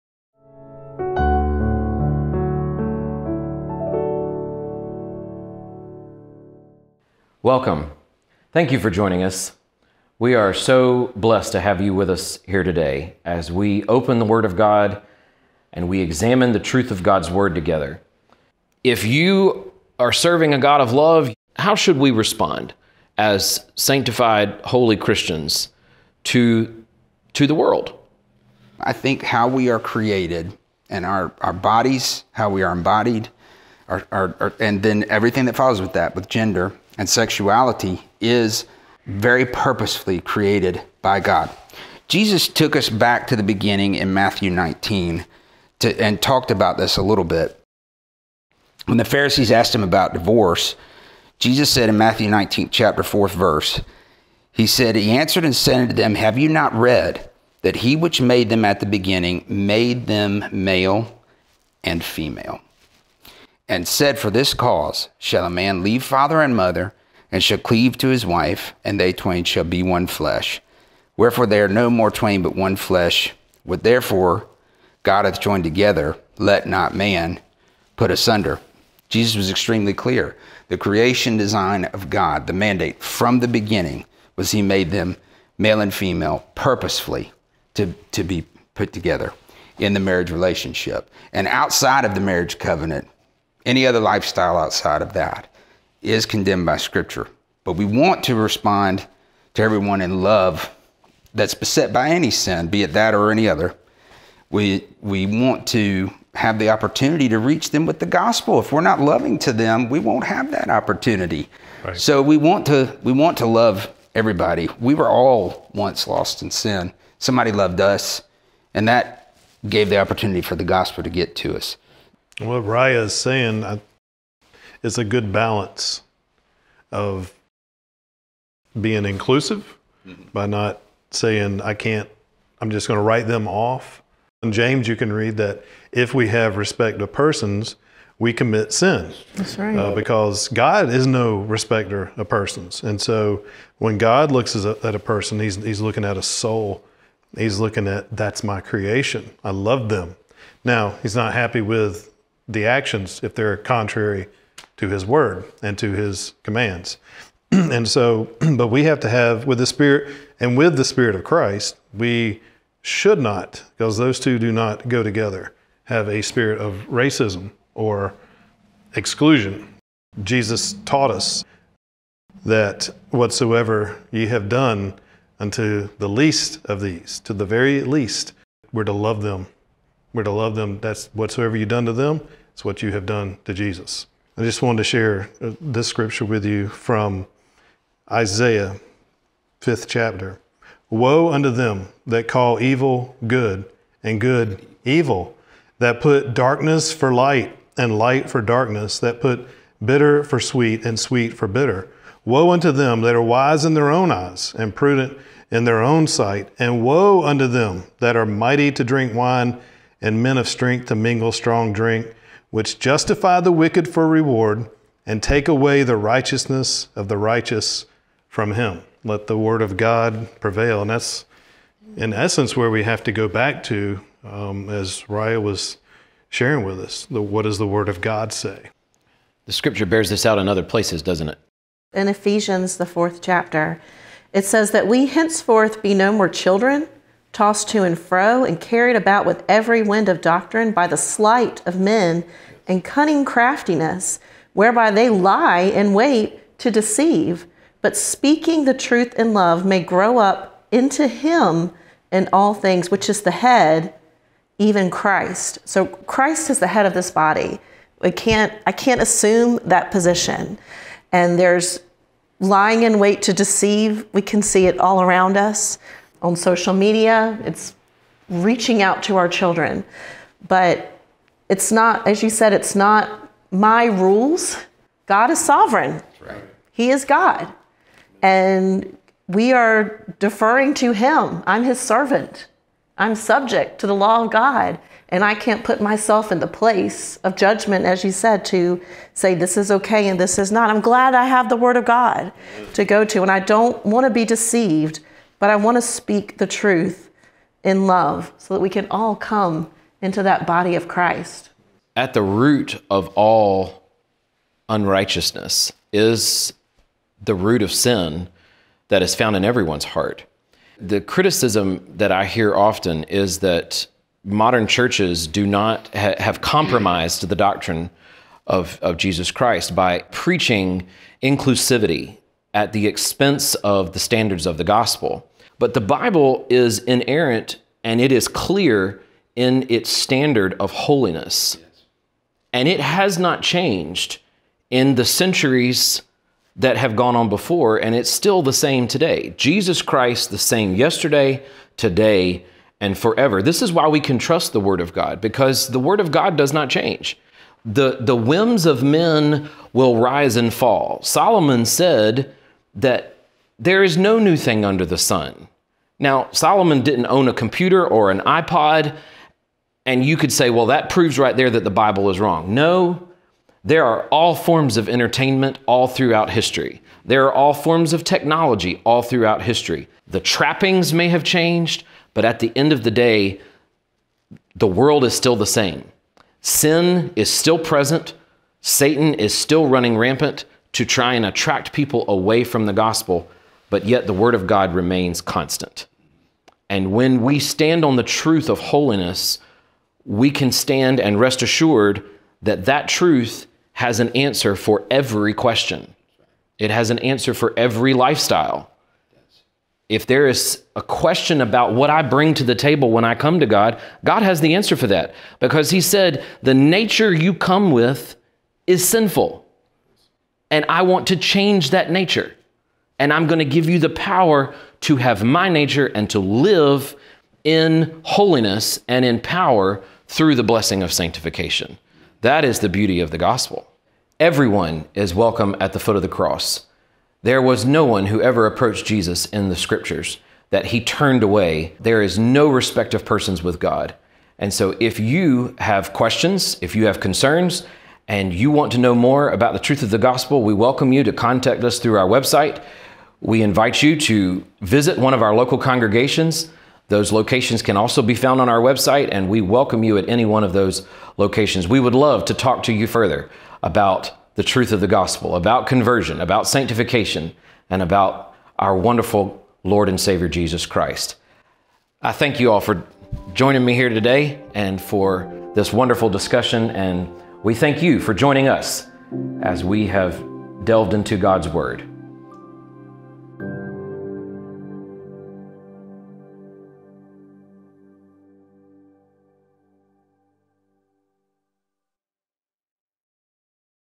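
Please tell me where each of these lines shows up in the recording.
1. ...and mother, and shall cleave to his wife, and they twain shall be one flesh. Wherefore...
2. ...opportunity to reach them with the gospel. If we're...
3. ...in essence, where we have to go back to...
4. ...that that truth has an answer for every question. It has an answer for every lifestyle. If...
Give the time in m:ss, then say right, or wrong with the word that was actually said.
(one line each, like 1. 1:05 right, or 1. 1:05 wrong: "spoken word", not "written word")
1. 1:06 right
2. 1:46 right
3. 3:41 right
4. 6:32 right.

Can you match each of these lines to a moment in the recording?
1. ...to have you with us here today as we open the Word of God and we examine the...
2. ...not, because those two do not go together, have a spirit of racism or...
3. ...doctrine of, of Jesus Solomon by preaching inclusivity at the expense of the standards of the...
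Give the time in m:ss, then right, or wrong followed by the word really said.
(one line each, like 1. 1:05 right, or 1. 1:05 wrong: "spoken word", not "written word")
1. 0:11 right
2. 2:43 right
3. 5:17 wrong: "Christ", not "Solomon".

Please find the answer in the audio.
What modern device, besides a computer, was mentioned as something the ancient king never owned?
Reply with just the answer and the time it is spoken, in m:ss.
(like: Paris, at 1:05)
iPod, at 5:58.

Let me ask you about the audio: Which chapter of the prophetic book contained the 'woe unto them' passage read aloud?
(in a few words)
Fifth chapter.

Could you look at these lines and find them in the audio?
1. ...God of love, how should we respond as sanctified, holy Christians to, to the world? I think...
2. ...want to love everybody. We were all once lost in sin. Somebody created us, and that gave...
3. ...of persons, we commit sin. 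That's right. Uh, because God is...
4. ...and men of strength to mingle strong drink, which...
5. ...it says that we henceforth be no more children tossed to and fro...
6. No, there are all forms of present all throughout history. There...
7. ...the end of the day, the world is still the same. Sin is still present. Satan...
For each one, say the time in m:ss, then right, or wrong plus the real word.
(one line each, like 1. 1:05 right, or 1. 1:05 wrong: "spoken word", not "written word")
1. 0:20 right
2. 1:53 wrong: "loved", not "created"
3. 2:17 right
4. 3:30 right
5. 3:54 right
6. 6:02 wrong: "entertainment", not "present"
7. 6:12 right.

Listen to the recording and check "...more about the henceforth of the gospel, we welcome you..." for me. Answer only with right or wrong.
wrong.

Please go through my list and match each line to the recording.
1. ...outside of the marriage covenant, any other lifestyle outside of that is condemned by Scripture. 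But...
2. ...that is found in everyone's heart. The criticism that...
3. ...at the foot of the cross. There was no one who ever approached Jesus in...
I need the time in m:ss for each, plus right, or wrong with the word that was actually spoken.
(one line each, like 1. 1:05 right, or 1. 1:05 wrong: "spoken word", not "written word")
1. 1:31 right
2. 5:08 right
3. 7:05 right.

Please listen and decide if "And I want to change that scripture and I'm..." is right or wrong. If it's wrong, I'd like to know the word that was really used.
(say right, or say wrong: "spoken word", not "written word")
wrong: "nature", not "scripture".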